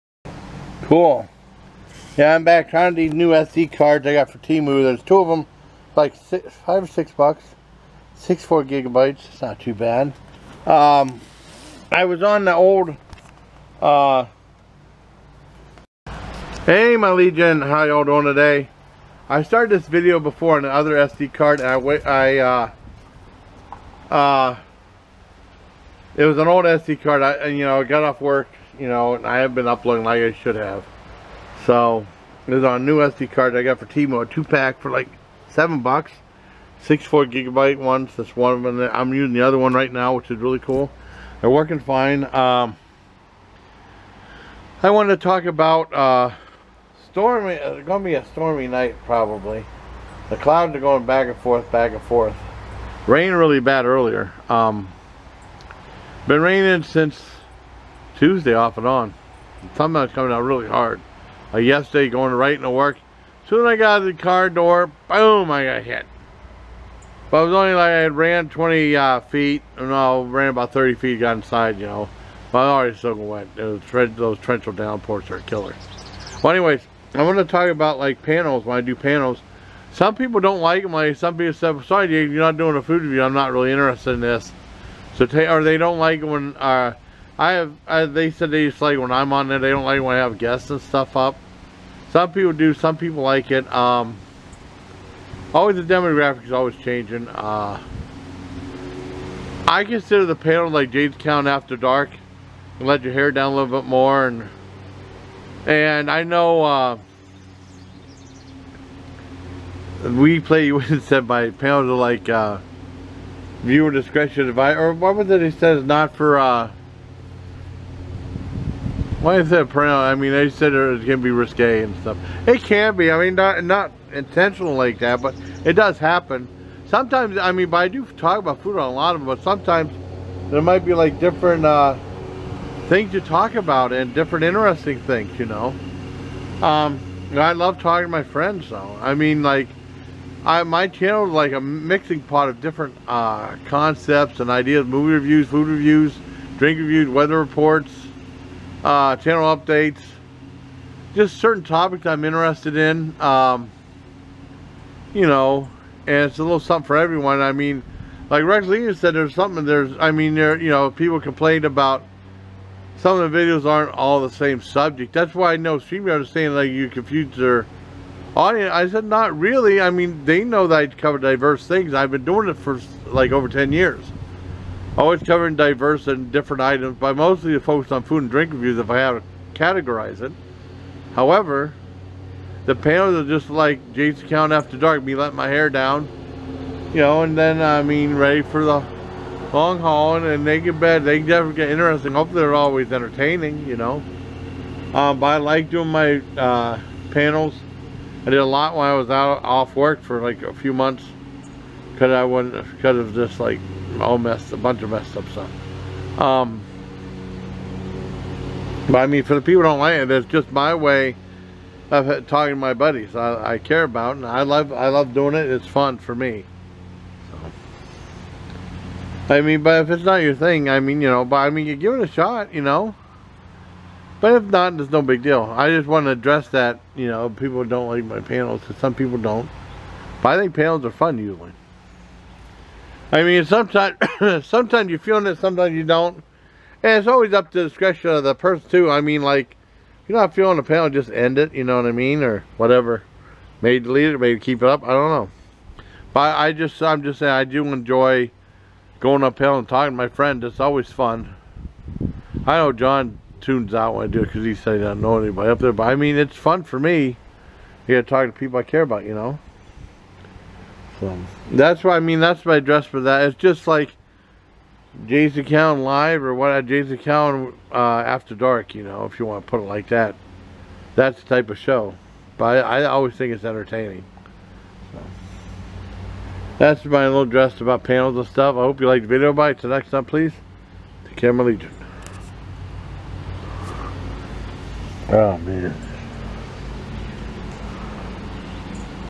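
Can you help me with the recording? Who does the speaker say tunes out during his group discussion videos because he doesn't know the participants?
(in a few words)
John.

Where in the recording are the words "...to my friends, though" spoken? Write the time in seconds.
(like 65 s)
138 s.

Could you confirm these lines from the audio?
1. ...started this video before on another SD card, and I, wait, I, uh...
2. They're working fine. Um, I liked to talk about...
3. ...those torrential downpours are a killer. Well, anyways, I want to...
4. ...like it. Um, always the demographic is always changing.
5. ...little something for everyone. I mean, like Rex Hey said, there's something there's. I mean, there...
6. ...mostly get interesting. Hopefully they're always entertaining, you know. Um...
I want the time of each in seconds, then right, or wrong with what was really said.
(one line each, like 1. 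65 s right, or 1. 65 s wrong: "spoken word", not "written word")
1. 19 s right
2. 41 s wrong: "wanted", not "liked"
3. 74 s right
4. 93 s right
5. 156 s wrong: "Lee", not "Hey"
6. 191 s wrong: "definitely", not "mostly".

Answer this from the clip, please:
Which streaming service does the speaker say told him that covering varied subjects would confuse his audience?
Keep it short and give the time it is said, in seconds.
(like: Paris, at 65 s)
StreamYard, at 165 s.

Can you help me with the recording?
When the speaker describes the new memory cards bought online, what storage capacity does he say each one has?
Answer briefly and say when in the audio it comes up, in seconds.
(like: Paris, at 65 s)
64 gigabytes, at 36 s.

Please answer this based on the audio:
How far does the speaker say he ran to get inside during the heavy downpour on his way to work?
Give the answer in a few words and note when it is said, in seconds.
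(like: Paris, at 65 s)
30 feet, at 70 s.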